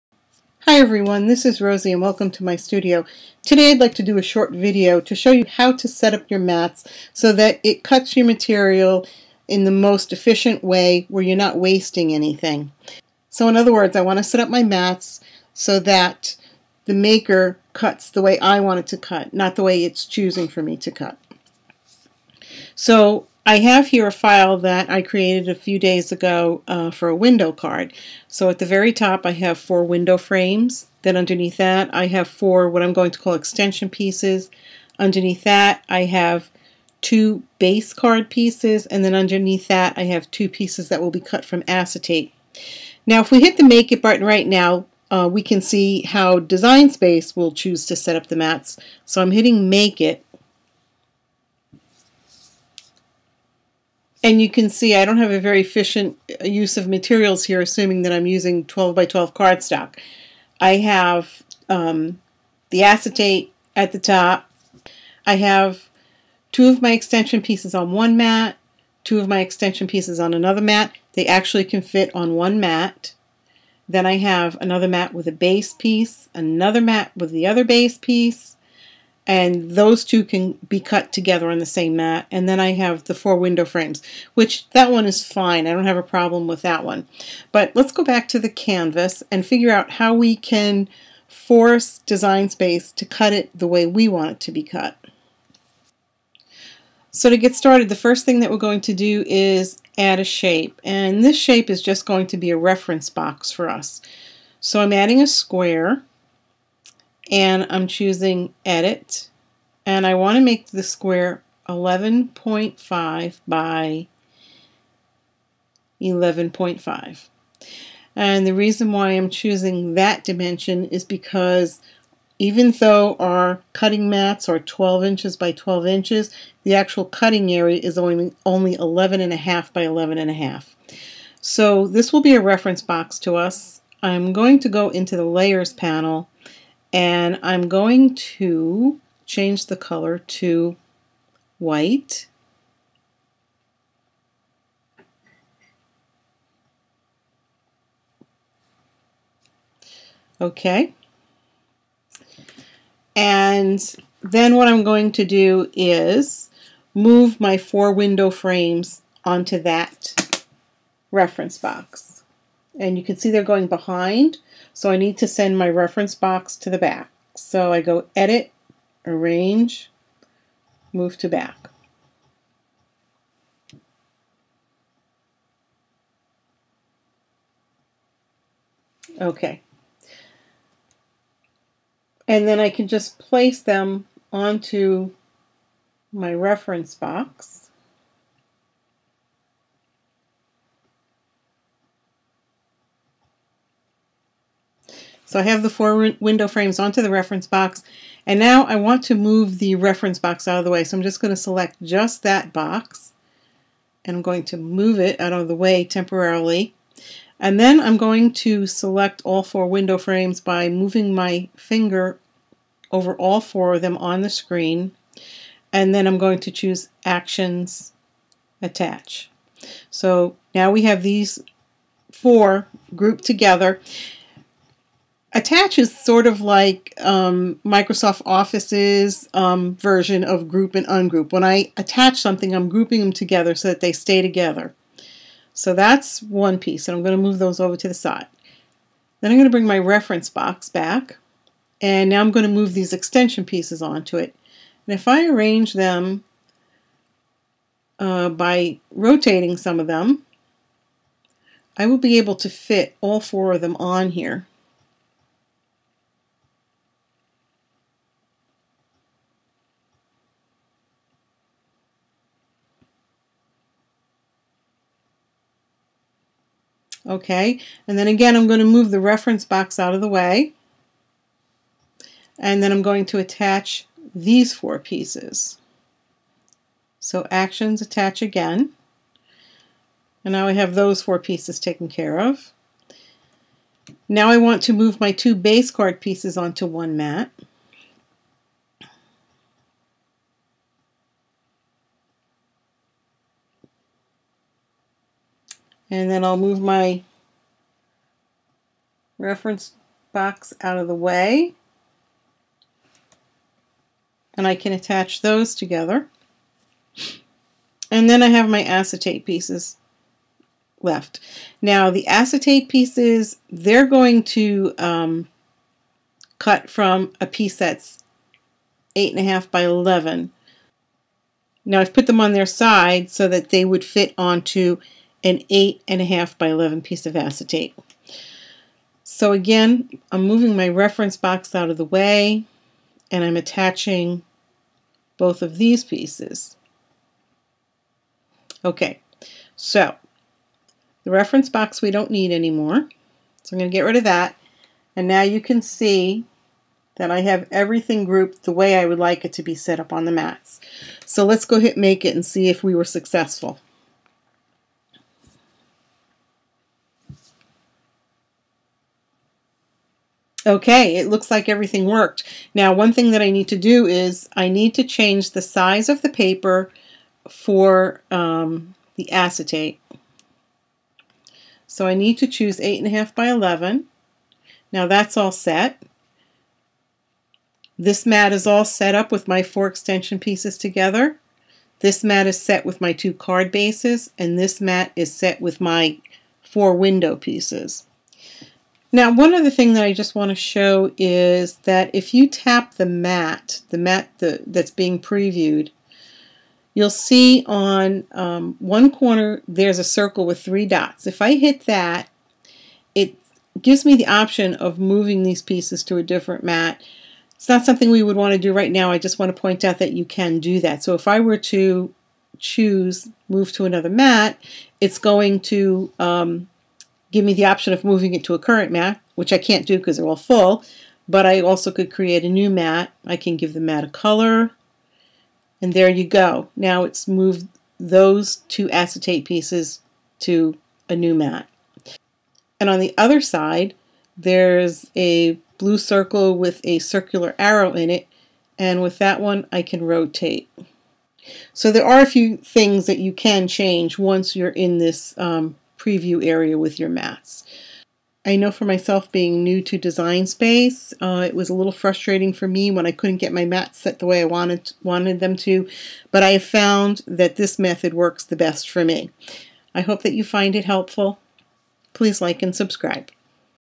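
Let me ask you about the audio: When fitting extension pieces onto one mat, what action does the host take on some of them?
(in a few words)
rotating.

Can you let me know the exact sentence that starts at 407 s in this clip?
It's not something we would want to do right now.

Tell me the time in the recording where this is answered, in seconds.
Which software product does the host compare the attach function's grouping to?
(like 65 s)
227 s.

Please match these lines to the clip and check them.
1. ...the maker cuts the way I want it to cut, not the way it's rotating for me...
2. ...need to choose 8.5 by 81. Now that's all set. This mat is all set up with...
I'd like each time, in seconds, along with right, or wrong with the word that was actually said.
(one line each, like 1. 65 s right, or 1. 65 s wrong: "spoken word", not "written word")
1. 16 s wrong: "choosing", not "rotating"
2. 371 s wrong: "11", not "81".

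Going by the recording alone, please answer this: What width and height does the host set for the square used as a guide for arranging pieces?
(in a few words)
11.5 by 11.5.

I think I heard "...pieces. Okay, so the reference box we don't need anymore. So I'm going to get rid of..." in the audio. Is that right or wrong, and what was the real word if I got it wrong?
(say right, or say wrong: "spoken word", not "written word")
right.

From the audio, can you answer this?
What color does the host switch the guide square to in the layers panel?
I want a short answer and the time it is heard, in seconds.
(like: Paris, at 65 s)
white, at 141 s.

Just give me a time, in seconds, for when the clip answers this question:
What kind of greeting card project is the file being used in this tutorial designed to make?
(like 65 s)
27 s.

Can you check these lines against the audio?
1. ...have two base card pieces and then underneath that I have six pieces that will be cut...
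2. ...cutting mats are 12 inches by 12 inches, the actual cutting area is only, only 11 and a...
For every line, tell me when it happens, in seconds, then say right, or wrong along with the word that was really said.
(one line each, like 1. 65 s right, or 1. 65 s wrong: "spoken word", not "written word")
1. 36 s wrong: "two", not "six"
2. 123 s right.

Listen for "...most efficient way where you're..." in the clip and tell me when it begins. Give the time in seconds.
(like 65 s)
9 s.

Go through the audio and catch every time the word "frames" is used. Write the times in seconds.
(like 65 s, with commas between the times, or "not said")
30 s, 83 s, 158 s, 196 s, 209 s.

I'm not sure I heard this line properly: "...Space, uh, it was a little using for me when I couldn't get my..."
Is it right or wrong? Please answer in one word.
wrong.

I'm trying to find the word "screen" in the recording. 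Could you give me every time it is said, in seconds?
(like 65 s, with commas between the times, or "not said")
214 s.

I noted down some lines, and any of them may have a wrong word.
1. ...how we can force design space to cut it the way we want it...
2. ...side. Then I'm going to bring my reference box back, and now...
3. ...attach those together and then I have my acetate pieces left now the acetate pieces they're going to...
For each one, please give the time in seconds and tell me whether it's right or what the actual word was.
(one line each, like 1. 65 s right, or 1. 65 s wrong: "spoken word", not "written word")
1. 89 s right
2. 237 s right
3. 304 s right.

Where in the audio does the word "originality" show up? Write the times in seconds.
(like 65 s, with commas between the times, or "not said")
not said.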